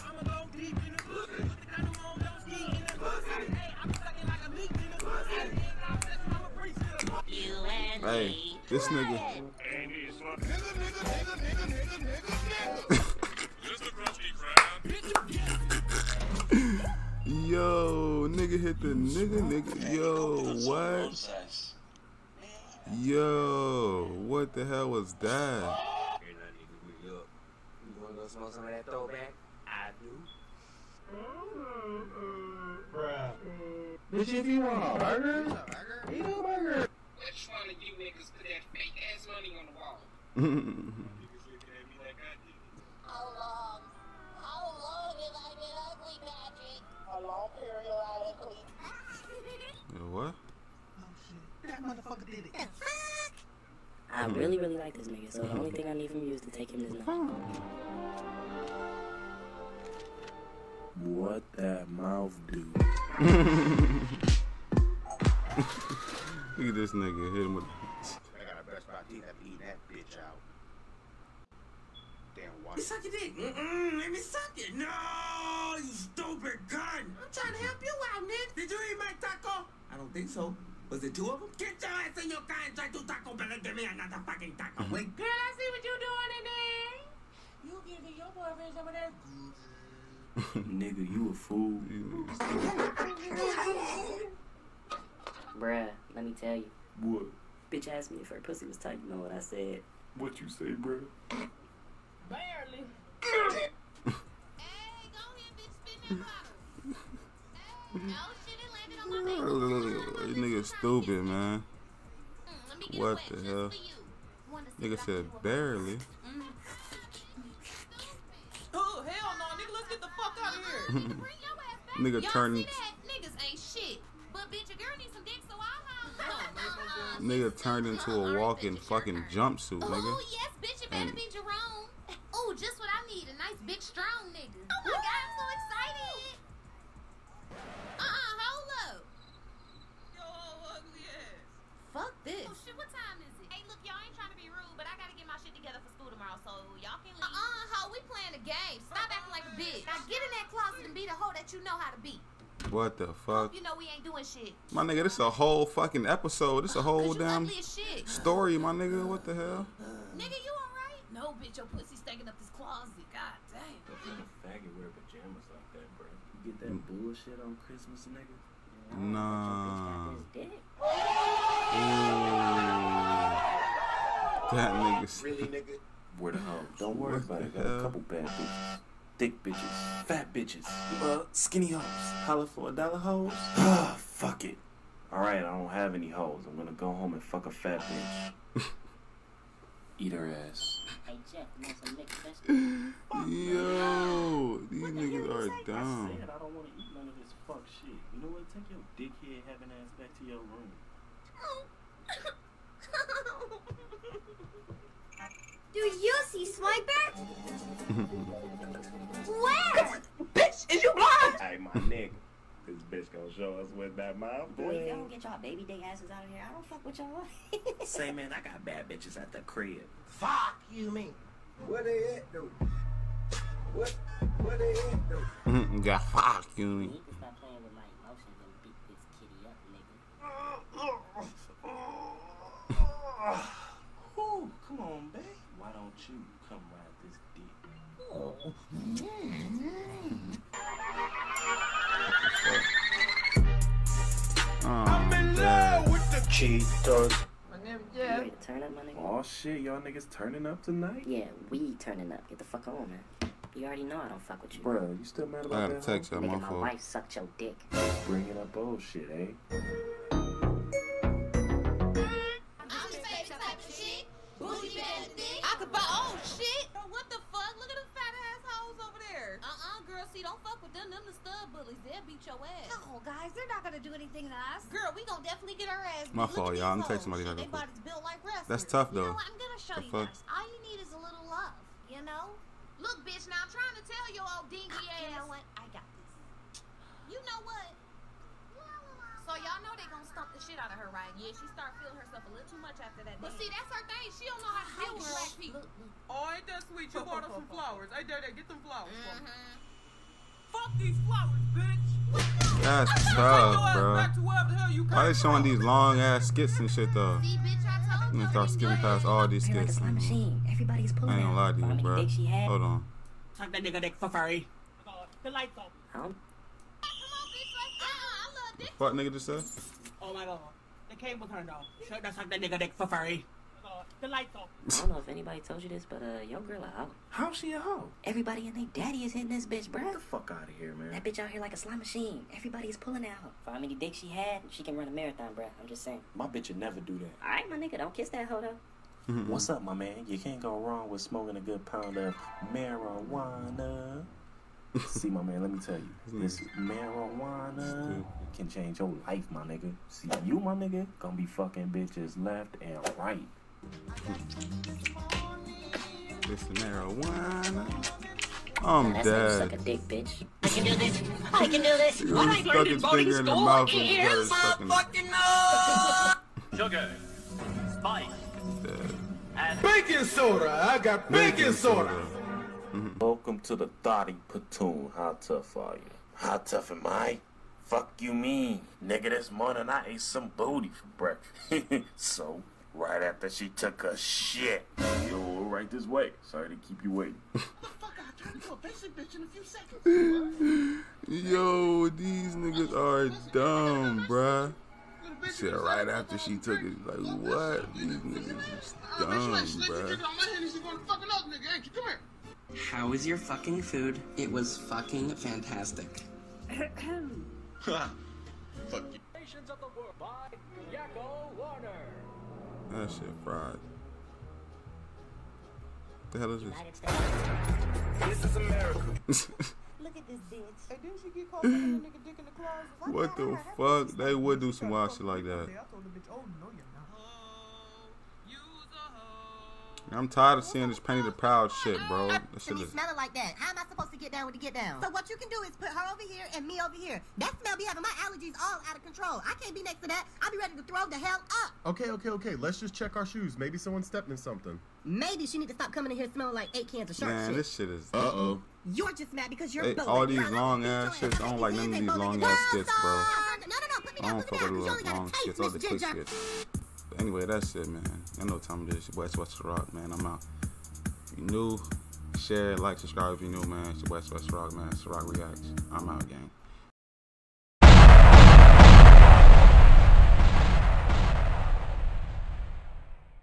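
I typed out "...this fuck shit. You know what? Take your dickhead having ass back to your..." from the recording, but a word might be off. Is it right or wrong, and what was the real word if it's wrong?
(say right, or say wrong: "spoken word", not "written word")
right.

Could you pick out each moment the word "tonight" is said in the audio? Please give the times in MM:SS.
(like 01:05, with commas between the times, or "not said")
04:10.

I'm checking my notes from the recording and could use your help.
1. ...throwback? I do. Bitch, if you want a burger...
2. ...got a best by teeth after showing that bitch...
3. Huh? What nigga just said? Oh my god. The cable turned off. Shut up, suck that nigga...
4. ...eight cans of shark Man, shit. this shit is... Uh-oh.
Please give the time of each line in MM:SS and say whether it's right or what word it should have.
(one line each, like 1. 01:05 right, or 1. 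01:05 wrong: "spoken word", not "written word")
1. 00:28 right
2. 01:08 wrong: "eating", not "showing"
3. 05:15 right
4. 07:26 right.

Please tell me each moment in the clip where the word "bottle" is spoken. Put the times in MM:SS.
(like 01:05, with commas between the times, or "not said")
01:47.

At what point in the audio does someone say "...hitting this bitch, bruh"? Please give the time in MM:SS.
05:29.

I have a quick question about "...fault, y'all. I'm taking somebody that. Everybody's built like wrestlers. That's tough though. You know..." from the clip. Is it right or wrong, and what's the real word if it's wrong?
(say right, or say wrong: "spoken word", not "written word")
right.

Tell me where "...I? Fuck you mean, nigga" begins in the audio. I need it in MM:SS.
06:16.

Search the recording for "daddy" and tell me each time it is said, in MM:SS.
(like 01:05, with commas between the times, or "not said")
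04:58, 05:28.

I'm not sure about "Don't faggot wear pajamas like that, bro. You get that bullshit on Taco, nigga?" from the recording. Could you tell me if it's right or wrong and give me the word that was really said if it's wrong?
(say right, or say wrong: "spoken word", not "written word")
wrong: "Christmas", not "Taco".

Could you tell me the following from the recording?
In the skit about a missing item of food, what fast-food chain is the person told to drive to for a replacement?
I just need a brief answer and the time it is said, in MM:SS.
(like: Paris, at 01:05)
Taco Bell, at 01:23.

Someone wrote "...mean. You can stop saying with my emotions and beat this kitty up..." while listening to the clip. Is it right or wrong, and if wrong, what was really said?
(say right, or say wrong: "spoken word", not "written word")
wrong: "playing", not "saying".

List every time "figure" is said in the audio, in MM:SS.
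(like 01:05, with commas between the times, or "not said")
not said.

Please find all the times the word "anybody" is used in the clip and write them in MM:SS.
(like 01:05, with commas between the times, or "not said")
05:25.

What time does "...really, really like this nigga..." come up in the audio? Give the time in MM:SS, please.
00:54.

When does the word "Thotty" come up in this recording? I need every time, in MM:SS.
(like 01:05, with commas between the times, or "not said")
06:13.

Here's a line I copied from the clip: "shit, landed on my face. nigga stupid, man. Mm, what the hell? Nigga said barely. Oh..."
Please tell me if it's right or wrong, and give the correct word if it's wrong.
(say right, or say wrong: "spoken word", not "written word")
right.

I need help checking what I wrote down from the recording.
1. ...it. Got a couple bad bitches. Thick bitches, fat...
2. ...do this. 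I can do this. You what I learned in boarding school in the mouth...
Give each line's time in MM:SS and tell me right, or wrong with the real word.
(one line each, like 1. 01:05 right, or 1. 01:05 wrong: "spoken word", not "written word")
1. 02:57 right
2. 06:00 right.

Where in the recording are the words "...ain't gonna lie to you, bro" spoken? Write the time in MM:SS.
05:11.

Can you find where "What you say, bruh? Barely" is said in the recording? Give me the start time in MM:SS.
01:40.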